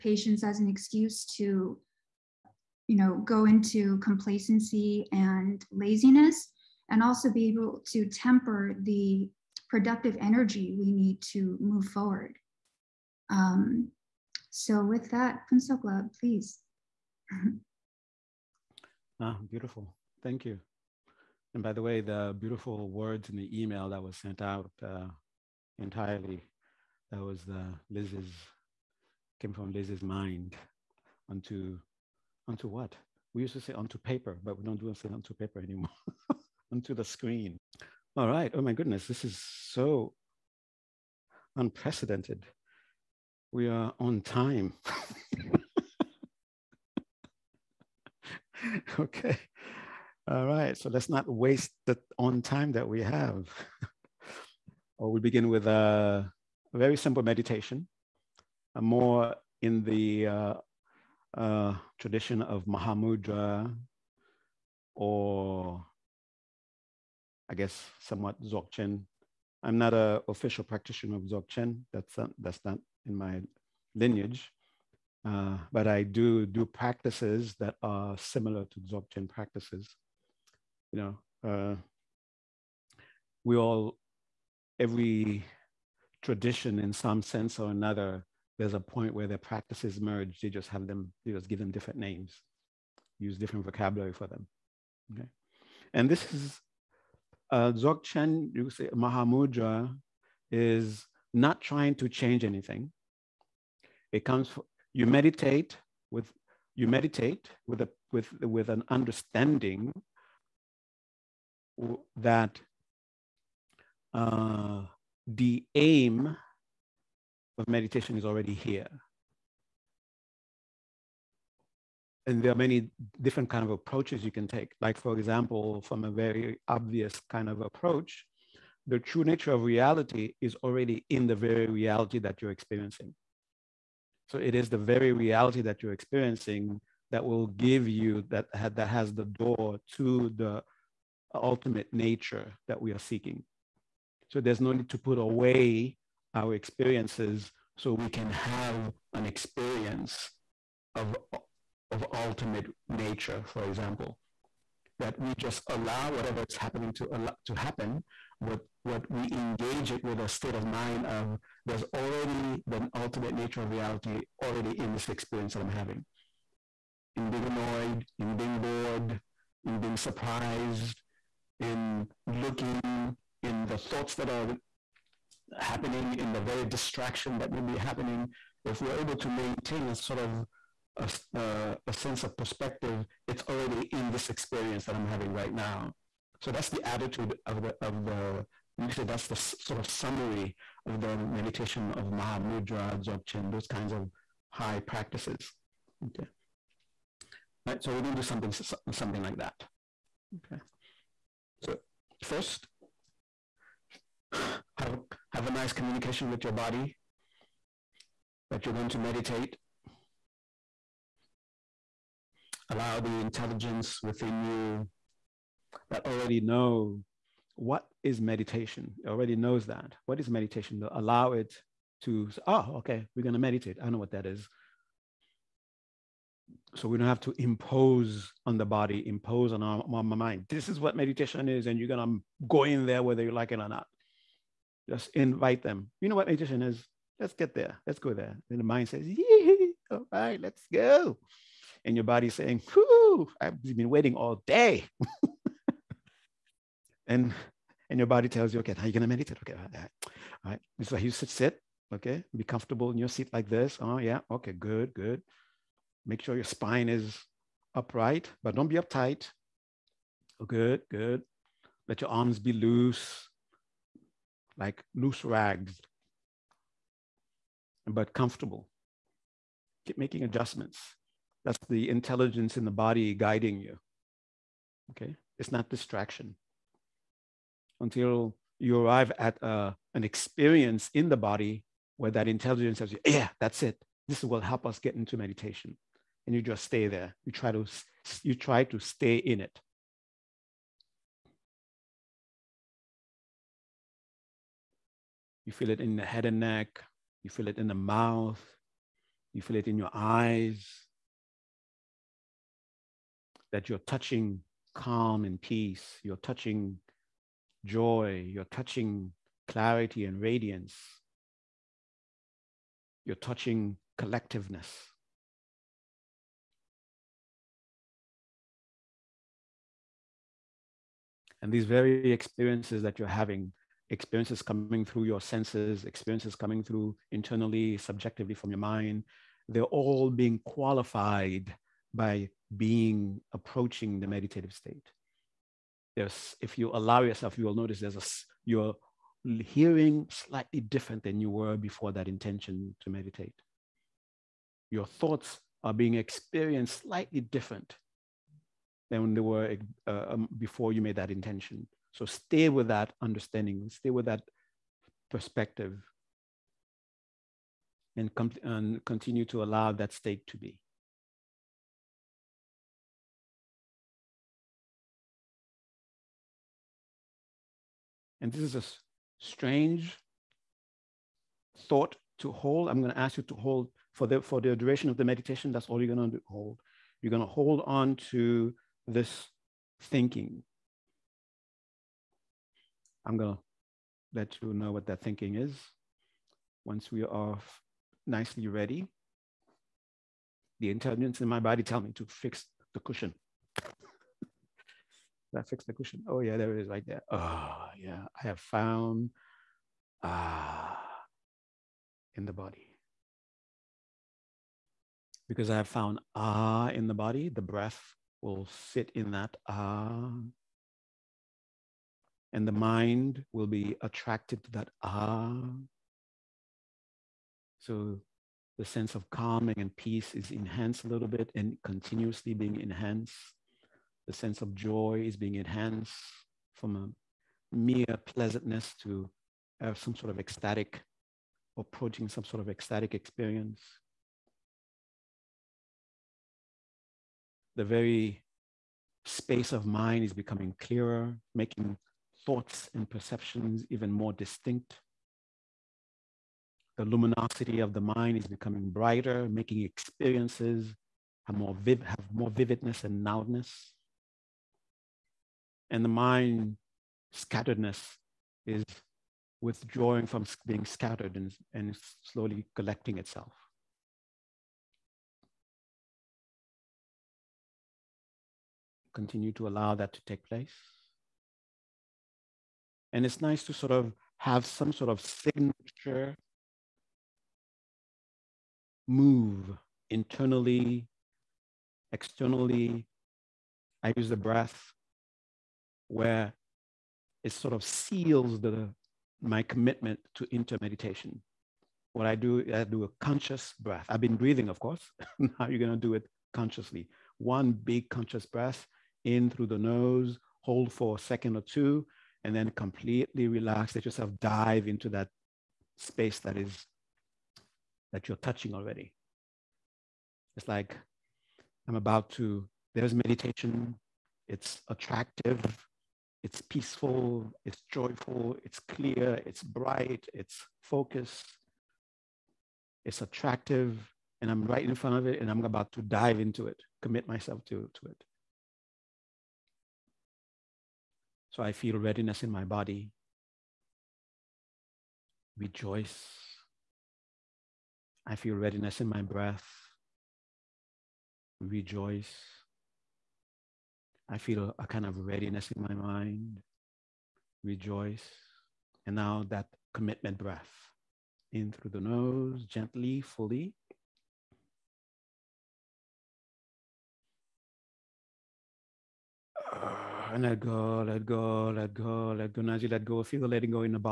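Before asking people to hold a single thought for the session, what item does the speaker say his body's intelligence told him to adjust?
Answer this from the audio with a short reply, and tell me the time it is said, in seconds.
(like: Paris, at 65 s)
the cushion, at 392 s.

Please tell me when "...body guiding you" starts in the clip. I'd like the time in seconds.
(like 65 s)
272 s.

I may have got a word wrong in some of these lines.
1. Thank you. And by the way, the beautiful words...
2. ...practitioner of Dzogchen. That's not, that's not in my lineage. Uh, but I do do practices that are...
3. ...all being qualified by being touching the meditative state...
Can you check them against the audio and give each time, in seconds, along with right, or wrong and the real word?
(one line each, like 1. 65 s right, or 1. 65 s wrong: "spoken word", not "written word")
1. 20 s right
2. 70 s right
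3. 329 s wrong: "approaching", not "touching".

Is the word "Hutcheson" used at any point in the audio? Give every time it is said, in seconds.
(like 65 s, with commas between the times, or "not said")
not said.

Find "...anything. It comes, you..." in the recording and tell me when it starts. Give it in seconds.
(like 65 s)
102 s.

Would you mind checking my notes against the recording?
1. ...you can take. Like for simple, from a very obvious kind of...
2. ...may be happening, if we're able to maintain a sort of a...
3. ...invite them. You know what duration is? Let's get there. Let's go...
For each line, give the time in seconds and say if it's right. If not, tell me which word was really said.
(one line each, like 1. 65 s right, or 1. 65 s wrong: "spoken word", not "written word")
1. 124 s wrong: "example", not "simple"
2. 177 s right
3. 235 s wrong: "meditation", not "duration".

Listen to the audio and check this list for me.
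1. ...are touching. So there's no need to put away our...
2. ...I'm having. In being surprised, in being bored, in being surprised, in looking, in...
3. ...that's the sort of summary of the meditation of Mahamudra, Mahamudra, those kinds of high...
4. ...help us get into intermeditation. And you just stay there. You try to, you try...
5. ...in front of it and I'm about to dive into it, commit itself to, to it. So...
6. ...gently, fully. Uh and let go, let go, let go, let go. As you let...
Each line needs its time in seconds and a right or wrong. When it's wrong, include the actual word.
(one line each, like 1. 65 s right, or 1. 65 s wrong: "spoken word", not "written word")
1. 142 s wrong: "seeking", not "touching"
2. 165 s wrong: "annoyed", not "surprised"
3. 189 s wrong: "Dzogchen", not "Mahamudra"
4. 284 s wrong: "meditation", not "intermeditation"
5. 524 s wrong: "myself", not "itself"
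6. 552 s right.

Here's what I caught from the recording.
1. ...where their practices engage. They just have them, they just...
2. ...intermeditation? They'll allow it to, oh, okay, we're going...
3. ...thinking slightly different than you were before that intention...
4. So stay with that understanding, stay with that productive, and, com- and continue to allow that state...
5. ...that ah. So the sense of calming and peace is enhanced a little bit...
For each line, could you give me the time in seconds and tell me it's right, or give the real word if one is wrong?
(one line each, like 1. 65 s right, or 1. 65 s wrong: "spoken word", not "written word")
1. 89 s wrong: "merge", not "engage"
2. 220 s wrong: "meditation", not "intermeditation"
3. 339 s wrong: "hearing", not "thinking"
4. 351 s wrong: "perspective", not "productive"
5. 414 s right.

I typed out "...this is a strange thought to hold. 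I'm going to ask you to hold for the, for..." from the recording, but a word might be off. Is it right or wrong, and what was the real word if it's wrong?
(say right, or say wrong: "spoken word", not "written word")
right.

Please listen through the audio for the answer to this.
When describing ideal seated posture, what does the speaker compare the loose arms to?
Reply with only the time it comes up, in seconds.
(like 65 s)
264 s.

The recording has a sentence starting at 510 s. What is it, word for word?
It's like I'm about to, there's meditation.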